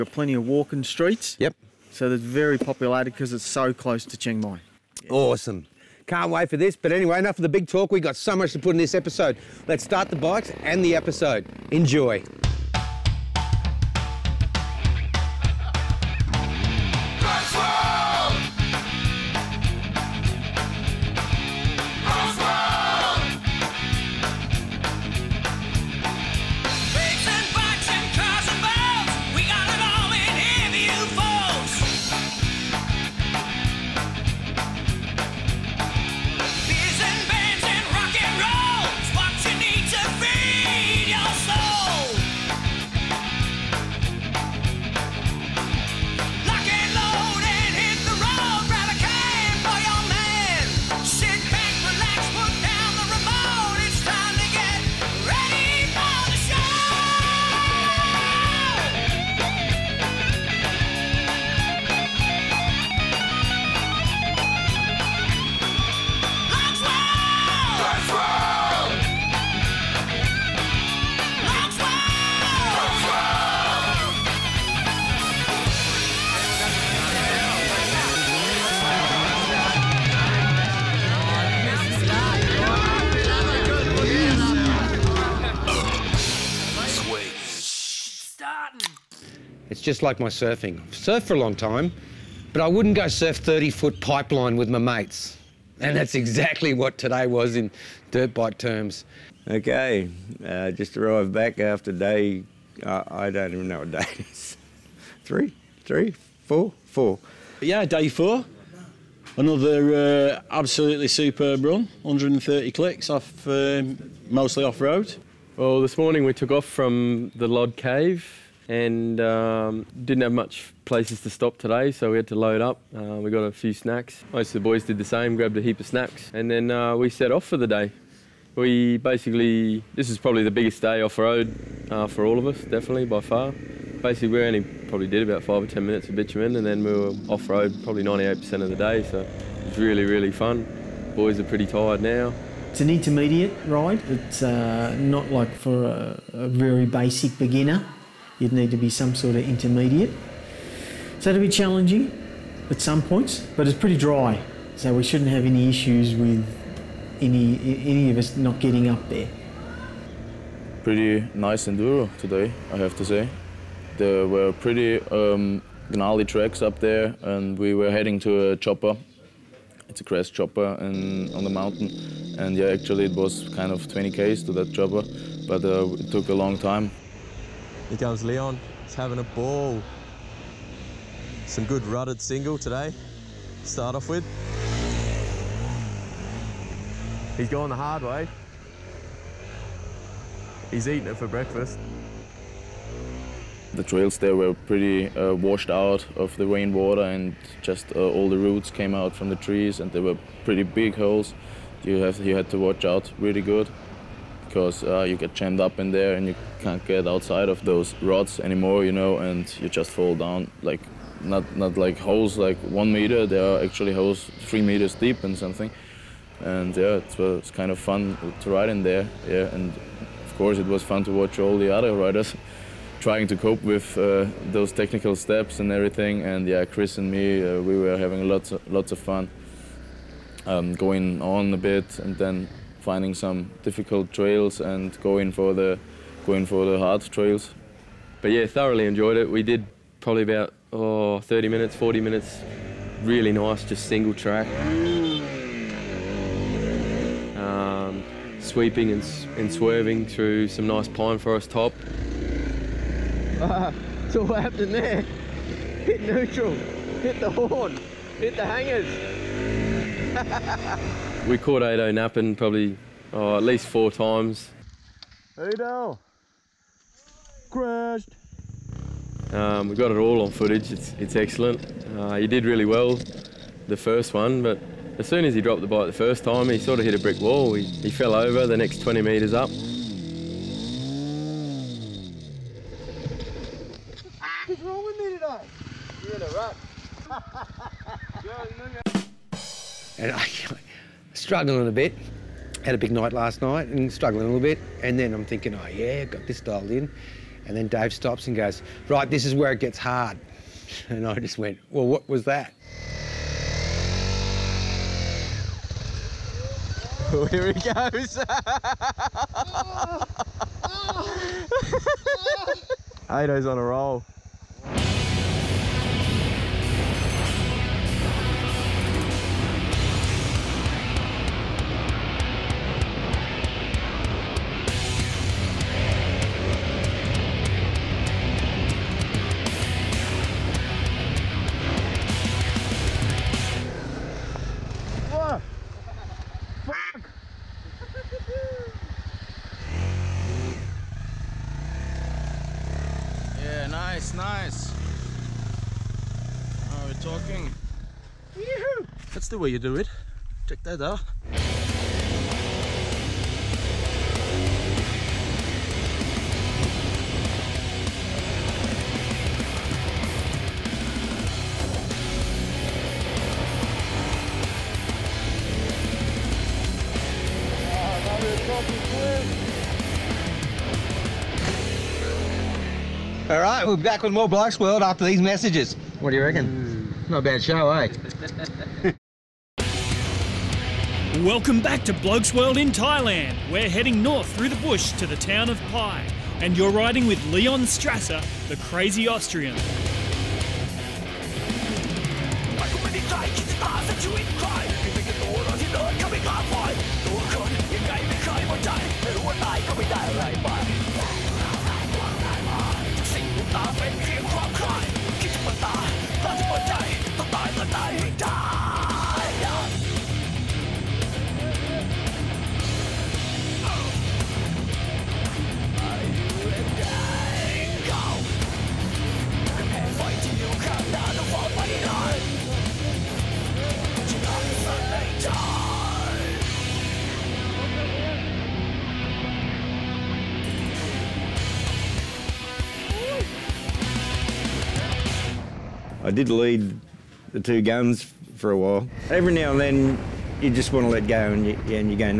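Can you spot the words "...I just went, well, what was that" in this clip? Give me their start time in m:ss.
5:01.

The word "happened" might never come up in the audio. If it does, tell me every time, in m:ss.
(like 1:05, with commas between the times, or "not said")
4:14.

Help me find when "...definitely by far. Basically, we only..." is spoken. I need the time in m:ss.
2:12.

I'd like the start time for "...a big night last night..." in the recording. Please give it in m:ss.
4:52.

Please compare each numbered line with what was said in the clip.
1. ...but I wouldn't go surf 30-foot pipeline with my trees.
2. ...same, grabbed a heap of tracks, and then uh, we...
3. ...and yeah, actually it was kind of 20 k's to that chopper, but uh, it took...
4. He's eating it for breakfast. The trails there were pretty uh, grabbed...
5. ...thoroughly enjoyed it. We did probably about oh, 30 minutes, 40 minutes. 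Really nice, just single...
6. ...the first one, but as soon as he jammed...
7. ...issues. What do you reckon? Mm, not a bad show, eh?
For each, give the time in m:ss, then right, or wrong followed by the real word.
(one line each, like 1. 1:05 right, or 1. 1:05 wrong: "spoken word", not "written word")
1. 1:32 wrong: "mates", not "trees"
2. 2:05 wrong: "snacks", not "tracks"
3. 2:52 right
4. 3:10 wrong: "washed", not "grabbed"
5. 3:58 right
6. 4:33 wrong: "dropped", not "jammed"
7. 6:15 wrong: "messages", not "issues".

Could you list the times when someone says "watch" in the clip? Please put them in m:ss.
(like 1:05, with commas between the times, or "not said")
3:22, 3:41.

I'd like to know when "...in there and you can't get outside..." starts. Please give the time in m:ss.
3:25.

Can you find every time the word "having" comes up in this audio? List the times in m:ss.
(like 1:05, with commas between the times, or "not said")
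2:58, 3:47.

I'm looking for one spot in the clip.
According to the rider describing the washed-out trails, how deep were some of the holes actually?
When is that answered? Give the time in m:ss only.
3:34.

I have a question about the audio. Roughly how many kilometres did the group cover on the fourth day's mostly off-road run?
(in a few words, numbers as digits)
130.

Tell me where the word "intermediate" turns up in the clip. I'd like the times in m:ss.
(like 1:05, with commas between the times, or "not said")
2:22, 2:29.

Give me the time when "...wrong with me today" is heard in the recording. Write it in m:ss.
4:44.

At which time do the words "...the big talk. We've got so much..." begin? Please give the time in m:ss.
0:07.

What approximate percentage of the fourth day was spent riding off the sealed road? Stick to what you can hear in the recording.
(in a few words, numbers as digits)
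98%.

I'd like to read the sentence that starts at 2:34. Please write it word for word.
So we shouldn't have any issues with any, any of us not getting up there.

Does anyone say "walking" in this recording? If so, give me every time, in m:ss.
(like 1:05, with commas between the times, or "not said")
0:00.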